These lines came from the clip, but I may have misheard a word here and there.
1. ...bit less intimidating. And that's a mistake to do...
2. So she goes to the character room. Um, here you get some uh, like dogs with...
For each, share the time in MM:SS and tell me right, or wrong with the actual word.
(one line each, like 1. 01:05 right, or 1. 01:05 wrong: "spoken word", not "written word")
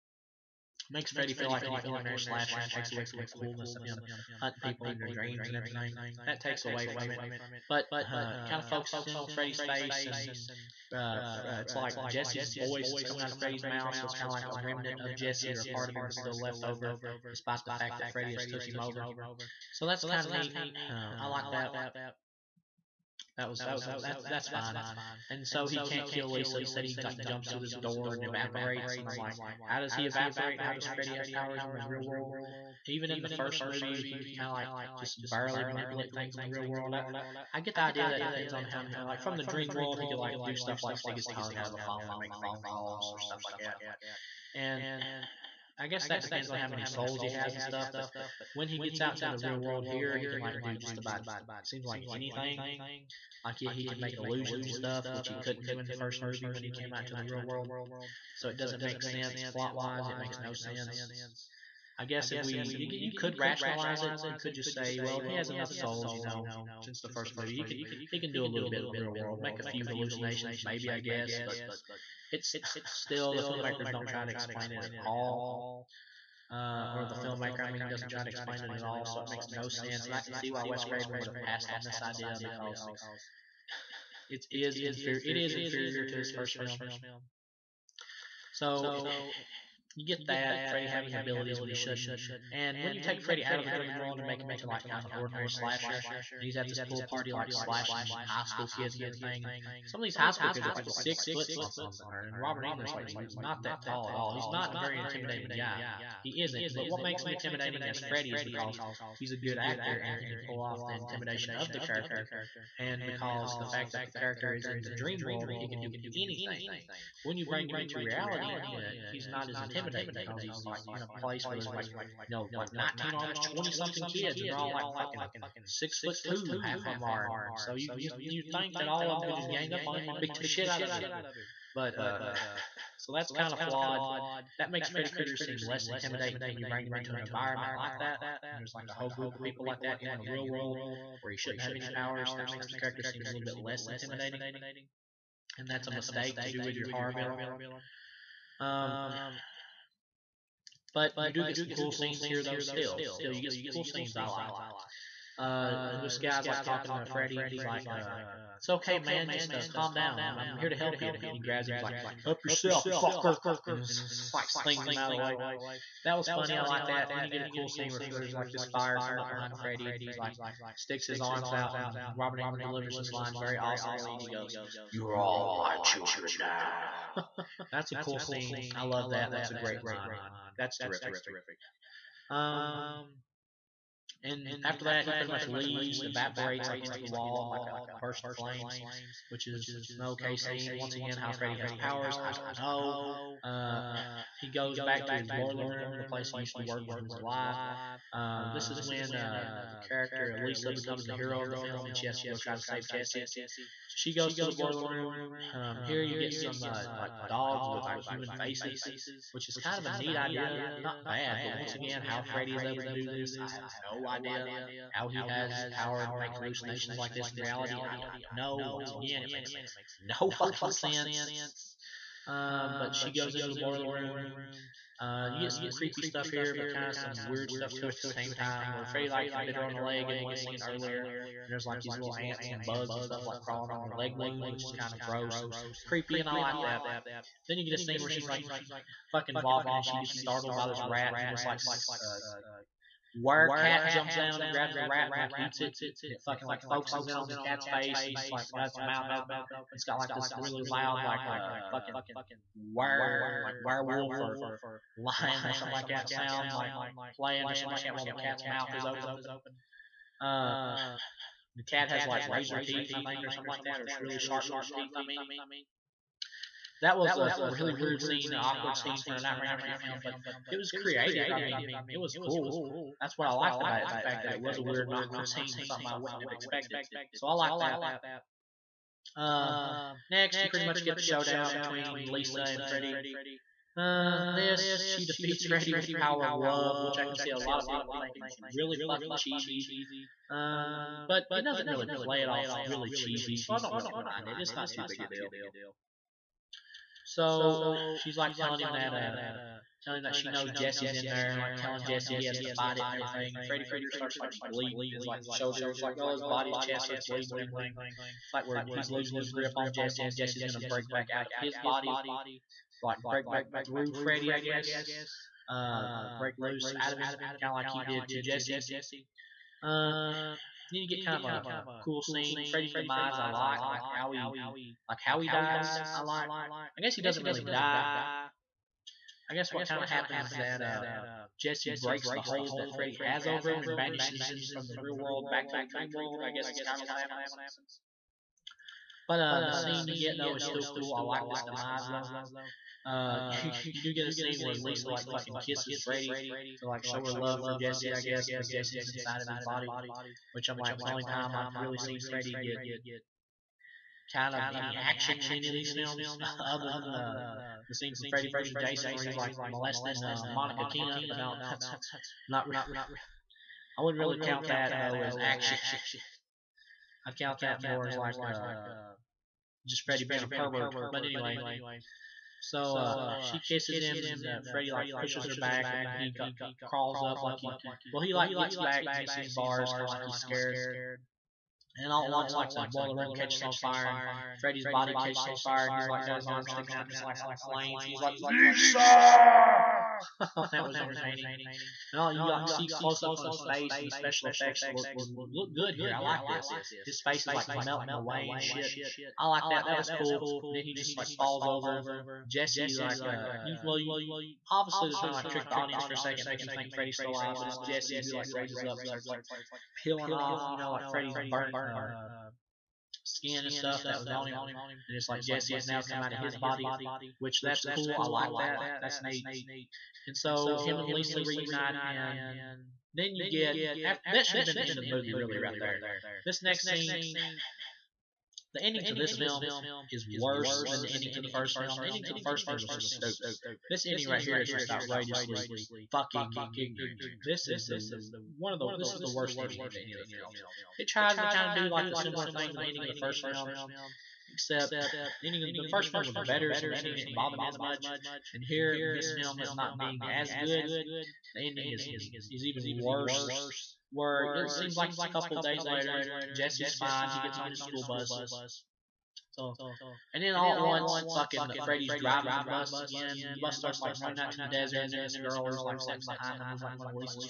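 1. 02:23 right
2. 03:23 wrong: "boiler", not "character".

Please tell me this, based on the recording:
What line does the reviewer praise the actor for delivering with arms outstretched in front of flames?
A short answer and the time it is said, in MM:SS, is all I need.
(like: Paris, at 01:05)
You're all my children now, at 02:54.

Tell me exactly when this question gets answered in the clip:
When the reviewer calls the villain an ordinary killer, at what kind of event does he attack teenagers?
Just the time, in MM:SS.
01:36.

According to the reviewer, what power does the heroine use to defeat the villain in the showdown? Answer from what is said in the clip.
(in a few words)
the power of love.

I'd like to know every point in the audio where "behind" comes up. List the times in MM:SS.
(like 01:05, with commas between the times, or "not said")
02:49, 07:46.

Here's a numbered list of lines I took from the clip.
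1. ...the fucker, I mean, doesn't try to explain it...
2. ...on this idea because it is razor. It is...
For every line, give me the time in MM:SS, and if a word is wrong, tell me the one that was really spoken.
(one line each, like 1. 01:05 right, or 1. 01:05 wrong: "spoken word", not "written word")
1. 01:17 wrong: "filmmaker", not "fucker"
2. 01:21 wrong: "inferior", not "razor".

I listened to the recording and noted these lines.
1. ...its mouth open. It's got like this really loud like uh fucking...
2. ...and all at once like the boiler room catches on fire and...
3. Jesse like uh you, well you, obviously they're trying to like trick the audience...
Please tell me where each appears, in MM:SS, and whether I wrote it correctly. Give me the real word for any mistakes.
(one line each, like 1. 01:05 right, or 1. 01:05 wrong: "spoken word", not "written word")
1. 04:08 right
2. 06:21 right
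3. 06:42 right.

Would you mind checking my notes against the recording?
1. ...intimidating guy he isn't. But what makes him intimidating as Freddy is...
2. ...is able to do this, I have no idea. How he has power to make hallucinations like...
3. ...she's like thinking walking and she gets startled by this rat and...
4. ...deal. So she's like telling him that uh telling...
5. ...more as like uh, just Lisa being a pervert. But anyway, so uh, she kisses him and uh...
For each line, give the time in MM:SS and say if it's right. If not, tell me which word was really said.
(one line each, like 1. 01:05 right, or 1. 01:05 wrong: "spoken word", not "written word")
1. 01:44 right
2. 03:32 right
3. 03:58 wrong: "fucking", not "thinking"
4. 04:55 right
5. 06:07 wrong: "Freddy", not "Lisa".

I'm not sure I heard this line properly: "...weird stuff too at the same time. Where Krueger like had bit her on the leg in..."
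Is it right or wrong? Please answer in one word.
wrong.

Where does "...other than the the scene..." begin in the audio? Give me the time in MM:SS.
05:56.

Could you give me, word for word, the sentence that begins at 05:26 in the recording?
I guess he doesn't really die.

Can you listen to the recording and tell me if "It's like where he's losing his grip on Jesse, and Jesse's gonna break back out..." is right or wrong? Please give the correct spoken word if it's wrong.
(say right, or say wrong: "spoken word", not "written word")
right.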